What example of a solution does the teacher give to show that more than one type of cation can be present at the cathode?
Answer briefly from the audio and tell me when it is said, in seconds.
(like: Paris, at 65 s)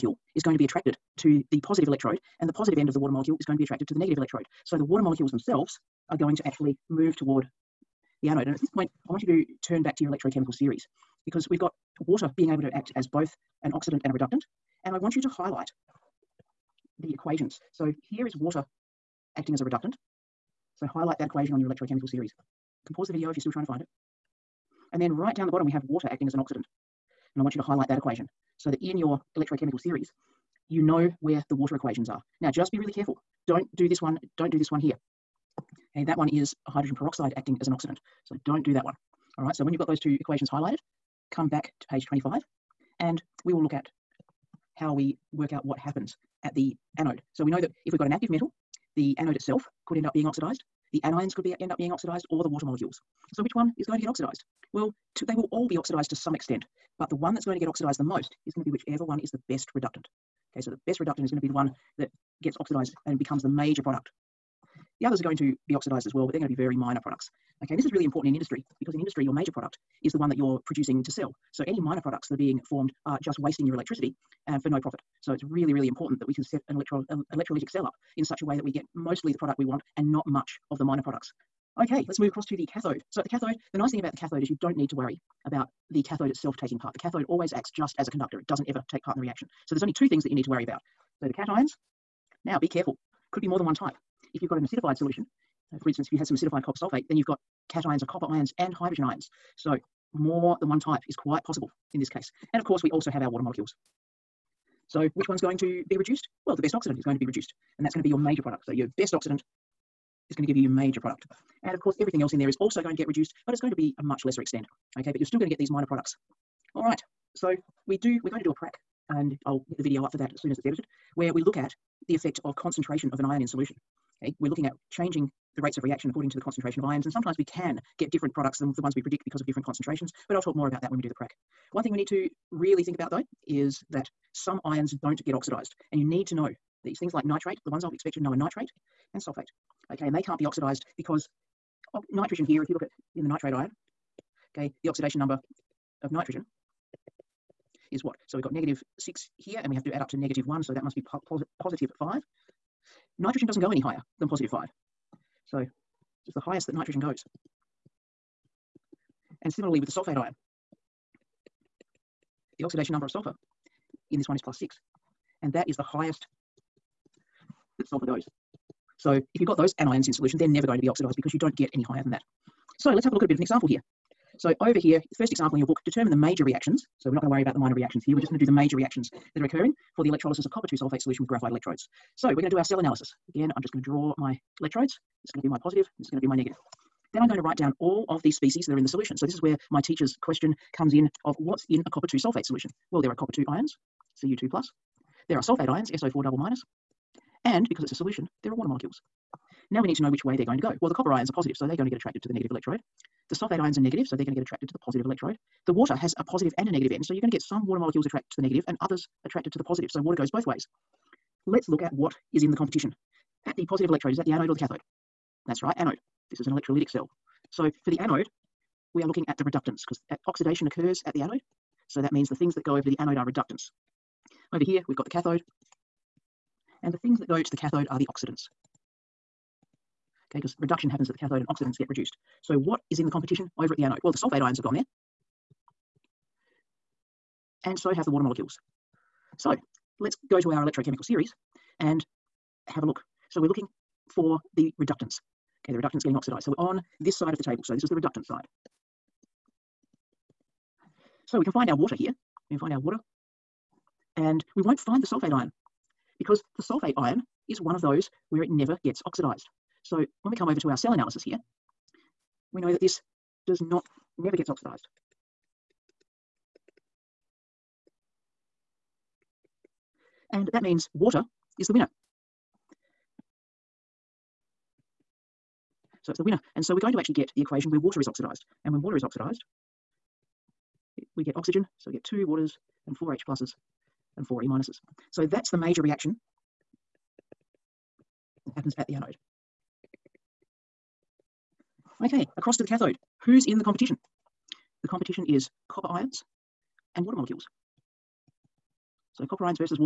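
Acidified copper sulfate, at 96 s.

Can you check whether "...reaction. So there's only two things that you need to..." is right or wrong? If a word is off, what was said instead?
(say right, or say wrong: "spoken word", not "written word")
right.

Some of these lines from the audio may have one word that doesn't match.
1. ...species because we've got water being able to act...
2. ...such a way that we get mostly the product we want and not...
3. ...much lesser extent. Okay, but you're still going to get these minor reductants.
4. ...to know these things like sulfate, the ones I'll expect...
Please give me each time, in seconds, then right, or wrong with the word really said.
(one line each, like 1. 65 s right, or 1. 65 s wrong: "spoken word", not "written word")
1. 10 s wrong: "series", not "species"
2. 78 s right
3. 114 s wrong: "products", not "reductants"
4. 136 s wrong: "nitrate", not "sulfate".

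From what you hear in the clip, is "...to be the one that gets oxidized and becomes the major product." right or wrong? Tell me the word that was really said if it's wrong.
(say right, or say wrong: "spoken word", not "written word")
right.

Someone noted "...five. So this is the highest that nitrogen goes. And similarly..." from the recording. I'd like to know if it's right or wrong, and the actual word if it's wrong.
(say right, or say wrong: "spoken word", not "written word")
right.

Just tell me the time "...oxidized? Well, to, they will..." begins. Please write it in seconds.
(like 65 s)
54 s.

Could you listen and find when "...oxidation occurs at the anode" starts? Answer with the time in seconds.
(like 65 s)
220 s.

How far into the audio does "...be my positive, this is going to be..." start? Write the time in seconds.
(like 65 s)
185 s.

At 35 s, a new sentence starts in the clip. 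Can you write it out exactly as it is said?
Okay, that one is hydrogen peroxide acting as an oxidant.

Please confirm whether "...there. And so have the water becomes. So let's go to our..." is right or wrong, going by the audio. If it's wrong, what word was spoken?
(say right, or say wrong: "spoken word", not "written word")
wrong: "molecules", not "becomes".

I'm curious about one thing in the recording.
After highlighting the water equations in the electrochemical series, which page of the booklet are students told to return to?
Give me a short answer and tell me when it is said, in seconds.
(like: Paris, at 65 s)
Page 25, at 41 s.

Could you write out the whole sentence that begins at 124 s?
Okay, we're looking at changing the rates of reaction according to the concentration of ions.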